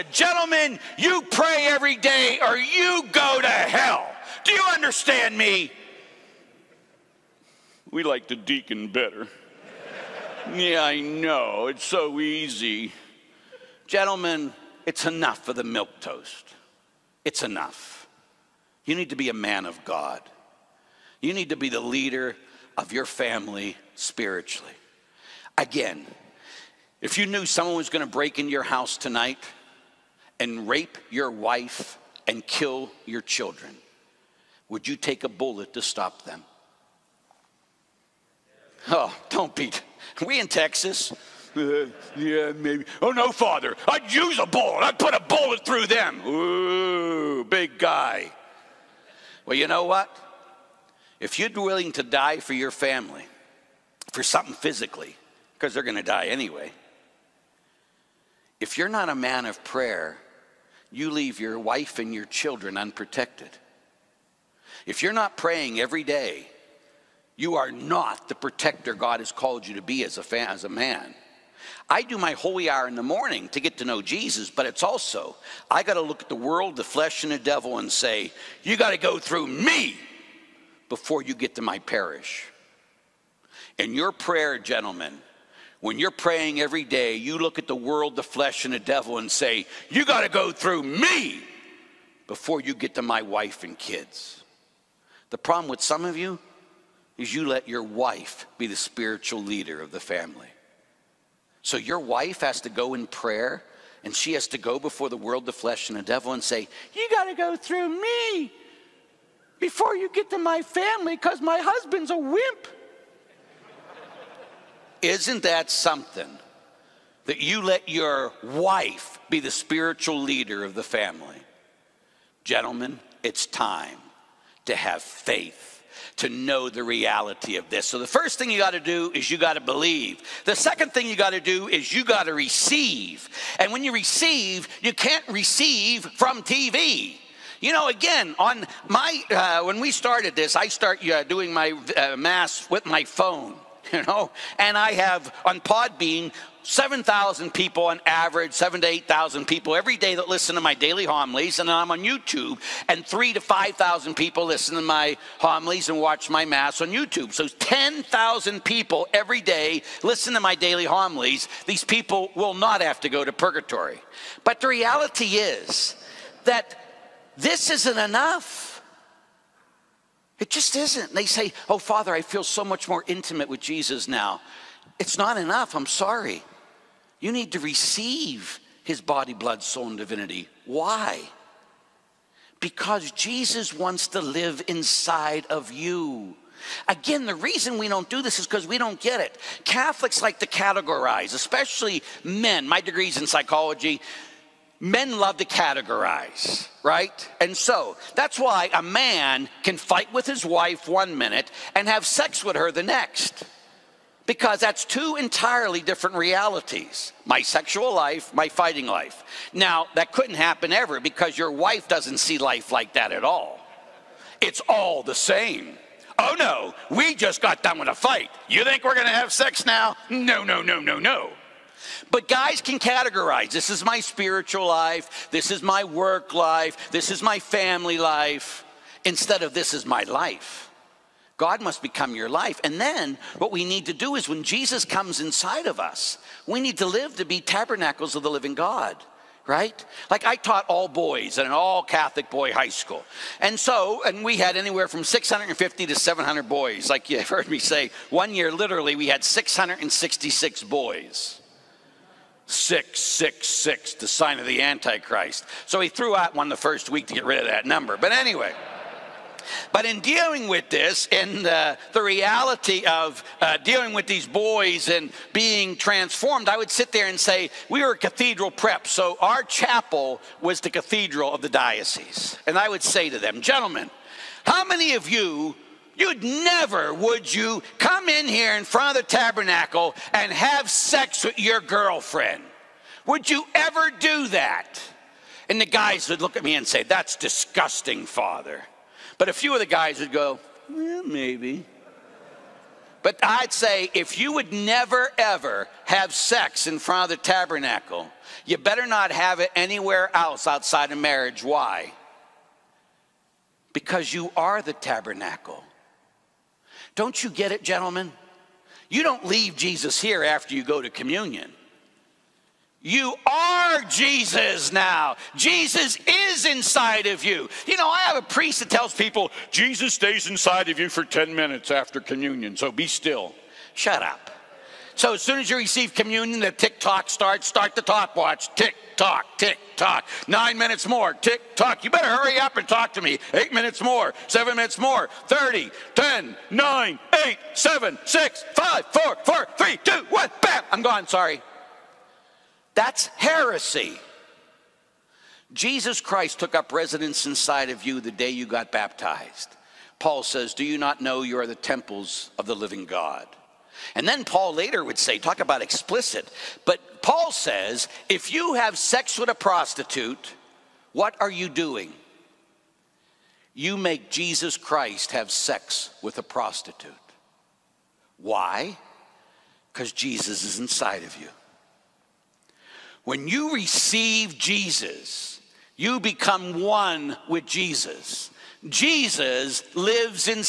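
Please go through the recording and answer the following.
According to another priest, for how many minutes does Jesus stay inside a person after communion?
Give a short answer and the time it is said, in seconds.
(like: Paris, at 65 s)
10, at 321 s.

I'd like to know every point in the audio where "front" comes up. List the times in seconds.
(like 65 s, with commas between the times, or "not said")
278 s, 296 s.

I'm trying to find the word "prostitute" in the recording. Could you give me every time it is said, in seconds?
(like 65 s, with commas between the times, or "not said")
359 s, 366 s.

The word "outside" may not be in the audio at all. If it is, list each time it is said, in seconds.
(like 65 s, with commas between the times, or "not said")
300 s.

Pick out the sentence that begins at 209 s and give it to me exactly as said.
Now, that couldn't happen ever because your wife doesn't see life like that at all.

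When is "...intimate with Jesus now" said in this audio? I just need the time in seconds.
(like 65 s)
173 s.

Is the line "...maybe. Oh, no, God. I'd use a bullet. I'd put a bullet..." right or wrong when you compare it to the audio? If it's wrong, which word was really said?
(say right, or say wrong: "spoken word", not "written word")
wrong: "Father", not "God".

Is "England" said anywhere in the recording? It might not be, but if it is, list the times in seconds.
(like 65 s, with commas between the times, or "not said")
not said.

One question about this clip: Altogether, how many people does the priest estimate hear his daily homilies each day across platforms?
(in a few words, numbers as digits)
10,000.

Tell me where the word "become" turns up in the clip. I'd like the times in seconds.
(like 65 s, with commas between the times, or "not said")
231 s, 375 s.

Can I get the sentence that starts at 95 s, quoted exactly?
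The problem with some of you is you let your wife be the spiritual leader of the family.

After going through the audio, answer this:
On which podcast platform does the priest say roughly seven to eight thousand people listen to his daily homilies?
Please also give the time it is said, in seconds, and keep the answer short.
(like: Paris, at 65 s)
Podbean, at 145 s.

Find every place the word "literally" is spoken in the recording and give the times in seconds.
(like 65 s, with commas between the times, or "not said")
248 s.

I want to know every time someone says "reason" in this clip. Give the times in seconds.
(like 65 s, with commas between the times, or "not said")
187 s.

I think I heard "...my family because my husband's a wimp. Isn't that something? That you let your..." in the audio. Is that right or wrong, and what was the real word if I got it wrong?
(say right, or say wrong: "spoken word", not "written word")
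right.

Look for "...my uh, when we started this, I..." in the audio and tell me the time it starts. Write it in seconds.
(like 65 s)
138 s.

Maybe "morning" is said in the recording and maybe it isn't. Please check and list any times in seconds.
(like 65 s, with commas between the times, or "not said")
73 s.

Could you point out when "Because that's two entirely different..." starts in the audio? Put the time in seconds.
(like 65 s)
204 s.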